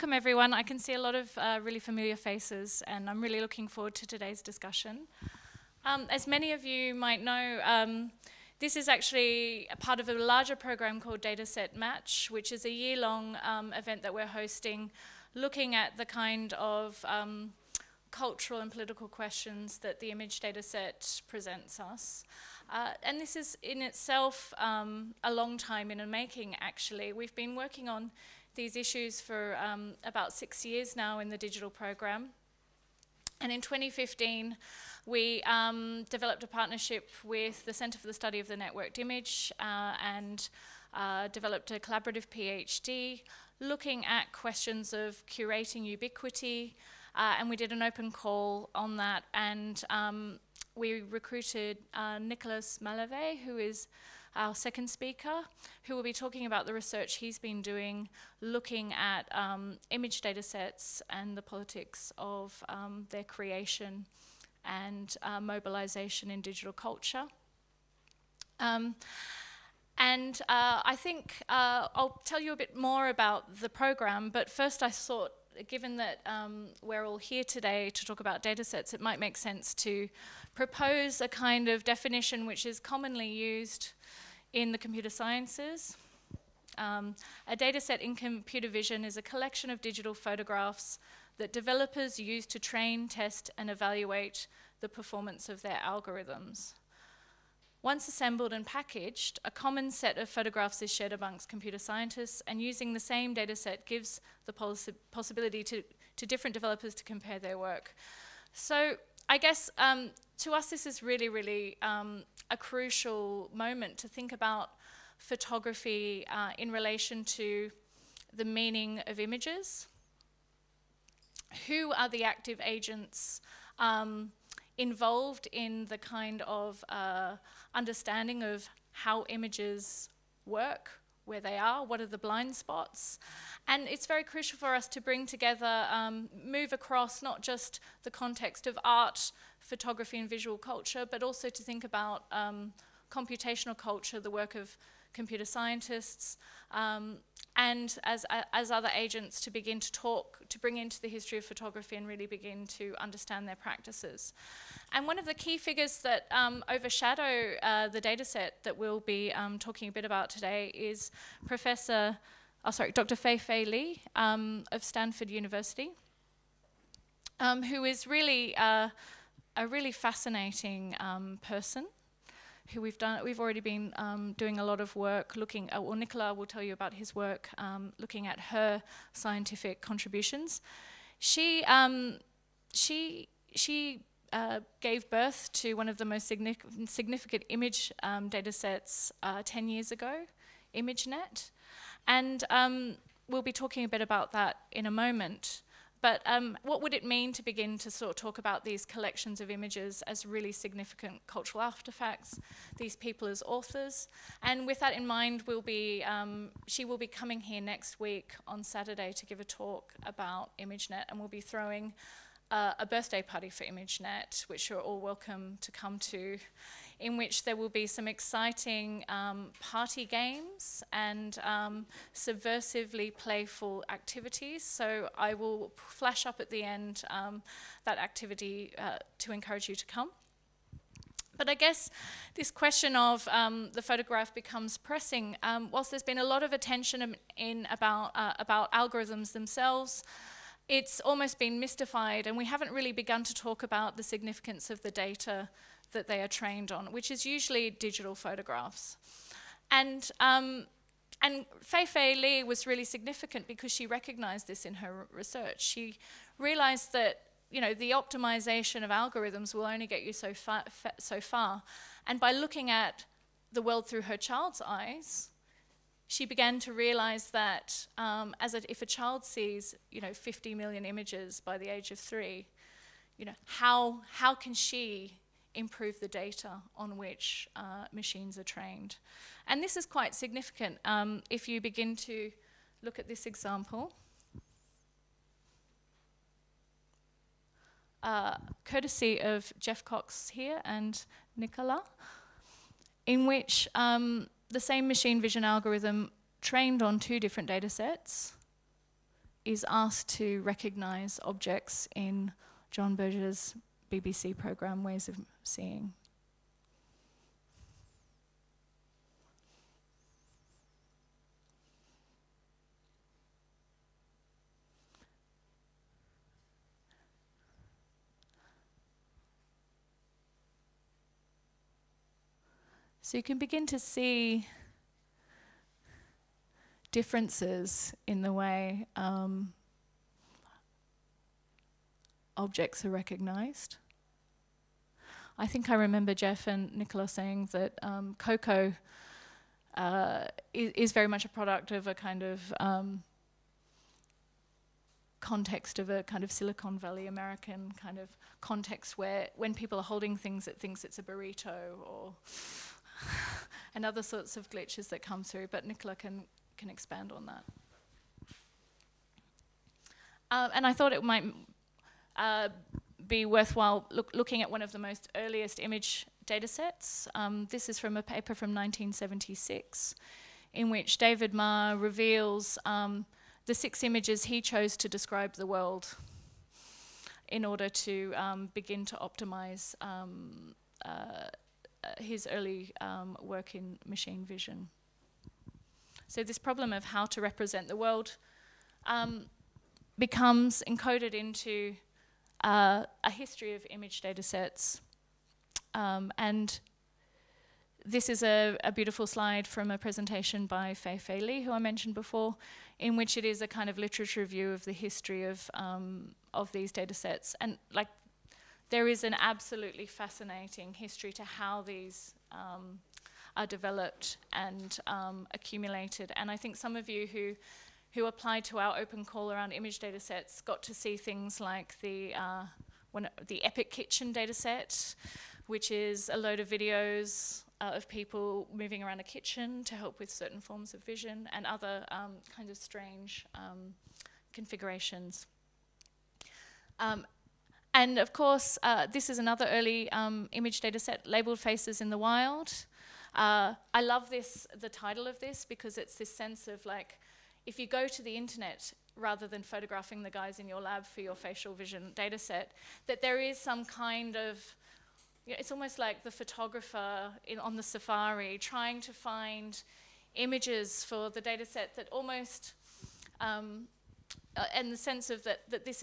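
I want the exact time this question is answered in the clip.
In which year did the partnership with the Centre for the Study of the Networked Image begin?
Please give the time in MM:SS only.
00:33.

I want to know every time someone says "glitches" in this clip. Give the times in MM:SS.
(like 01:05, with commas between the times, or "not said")
05:54.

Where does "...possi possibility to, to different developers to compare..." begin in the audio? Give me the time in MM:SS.
01:44.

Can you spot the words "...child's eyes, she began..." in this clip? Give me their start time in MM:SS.
04:24.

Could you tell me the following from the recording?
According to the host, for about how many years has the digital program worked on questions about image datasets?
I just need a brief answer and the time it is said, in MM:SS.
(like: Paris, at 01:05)
6 years, at 00:30.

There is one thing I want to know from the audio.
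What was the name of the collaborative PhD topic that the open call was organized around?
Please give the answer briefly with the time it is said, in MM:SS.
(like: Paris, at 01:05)
curating ubiquity, at 00:45.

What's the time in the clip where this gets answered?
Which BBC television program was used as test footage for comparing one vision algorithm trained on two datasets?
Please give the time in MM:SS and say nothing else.
05:04.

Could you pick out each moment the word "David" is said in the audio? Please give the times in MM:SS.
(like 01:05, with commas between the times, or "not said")
06:10.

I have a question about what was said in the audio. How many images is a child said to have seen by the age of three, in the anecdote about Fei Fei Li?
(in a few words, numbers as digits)
50 million.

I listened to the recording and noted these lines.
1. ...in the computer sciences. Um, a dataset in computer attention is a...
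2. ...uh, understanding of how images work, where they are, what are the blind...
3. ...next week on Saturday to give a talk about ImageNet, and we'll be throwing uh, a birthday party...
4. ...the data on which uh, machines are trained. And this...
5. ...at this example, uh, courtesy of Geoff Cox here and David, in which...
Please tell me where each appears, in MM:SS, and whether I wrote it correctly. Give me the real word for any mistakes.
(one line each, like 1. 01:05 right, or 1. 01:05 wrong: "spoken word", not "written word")
1. 01:24 wrong: "vision", not "attention"
2. 02:06 right
3. 03:27 right
4. 04:35 right
5. 04:42 wrong: "Nicola", not "David".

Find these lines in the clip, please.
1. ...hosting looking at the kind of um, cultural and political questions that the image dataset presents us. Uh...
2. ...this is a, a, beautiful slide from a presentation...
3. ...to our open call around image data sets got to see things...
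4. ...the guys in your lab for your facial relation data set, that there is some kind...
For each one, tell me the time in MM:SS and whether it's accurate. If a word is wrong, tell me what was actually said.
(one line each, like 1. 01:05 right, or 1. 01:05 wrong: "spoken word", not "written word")
1. 00:14 right
2. 06:37 right
3. 06:58 right
4. 07:30 wrong: "vision", not "relation".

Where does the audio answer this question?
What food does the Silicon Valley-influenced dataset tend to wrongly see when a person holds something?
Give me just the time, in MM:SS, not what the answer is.
05:51.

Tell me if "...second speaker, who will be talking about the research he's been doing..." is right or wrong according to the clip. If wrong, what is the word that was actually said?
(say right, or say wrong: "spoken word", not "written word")
right.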